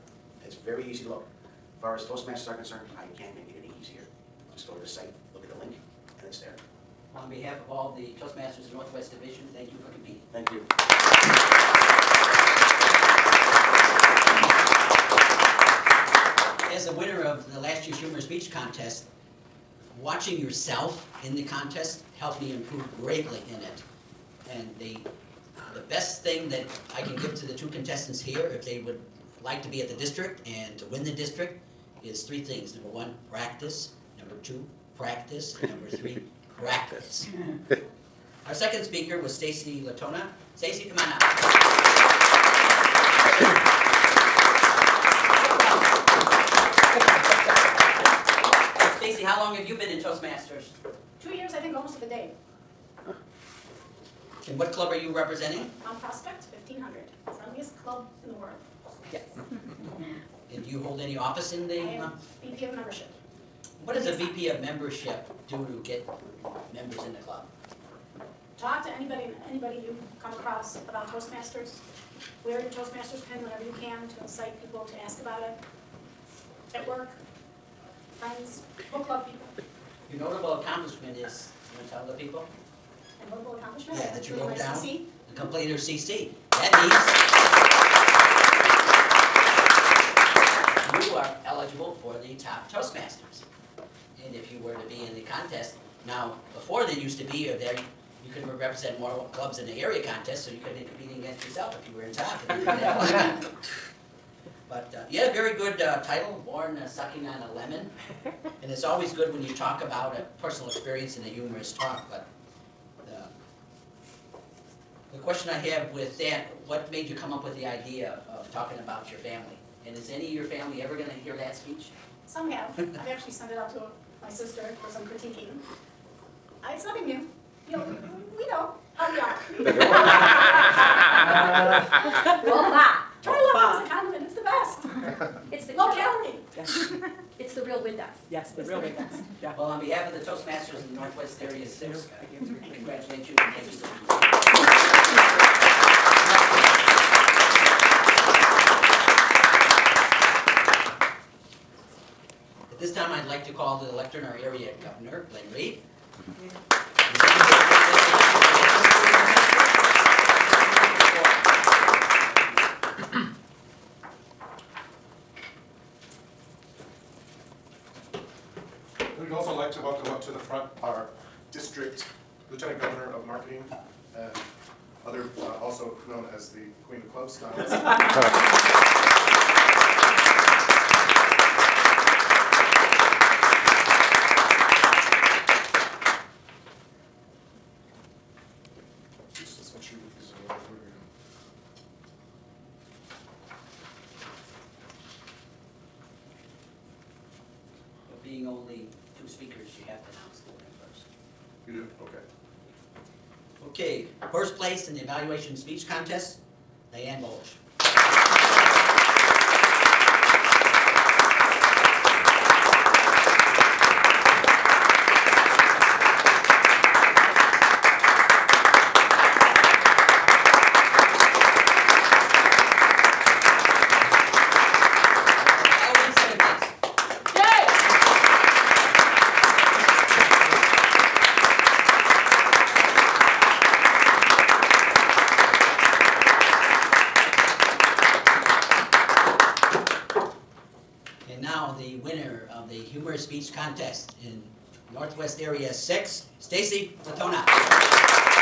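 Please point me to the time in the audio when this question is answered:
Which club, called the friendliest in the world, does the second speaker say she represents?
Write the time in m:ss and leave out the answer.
0:55.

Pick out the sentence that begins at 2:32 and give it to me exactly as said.
This time I'd like to call the lectern our area governor, Glenn Reed.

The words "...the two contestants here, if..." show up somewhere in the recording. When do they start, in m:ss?
0:27.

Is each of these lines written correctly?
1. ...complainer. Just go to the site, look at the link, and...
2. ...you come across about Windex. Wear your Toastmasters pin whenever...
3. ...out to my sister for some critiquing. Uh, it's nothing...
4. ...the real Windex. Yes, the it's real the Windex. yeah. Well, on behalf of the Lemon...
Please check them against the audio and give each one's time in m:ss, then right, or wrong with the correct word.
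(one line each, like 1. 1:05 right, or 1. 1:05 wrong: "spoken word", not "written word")
1. 0:03 wrong: "easier", not "complainer"
2. 1:09 wrong: "Toastmasters", not "Windex"
3. 2:03 right
4. 2:17 wrong: "Toastmasters", not "Lemon".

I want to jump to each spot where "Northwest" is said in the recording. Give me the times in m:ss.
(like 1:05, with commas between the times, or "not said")
0:08, 2:21.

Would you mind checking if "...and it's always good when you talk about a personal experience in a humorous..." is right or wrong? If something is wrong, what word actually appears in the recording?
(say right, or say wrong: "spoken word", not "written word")
right.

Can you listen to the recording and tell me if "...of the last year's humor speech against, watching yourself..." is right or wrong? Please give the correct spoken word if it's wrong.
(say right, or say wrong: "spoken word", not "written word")
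wrong: "contest", not "against".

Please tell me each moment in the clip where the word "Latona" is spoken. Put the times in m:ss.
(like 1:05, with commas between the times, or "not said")
0:39, 4:07.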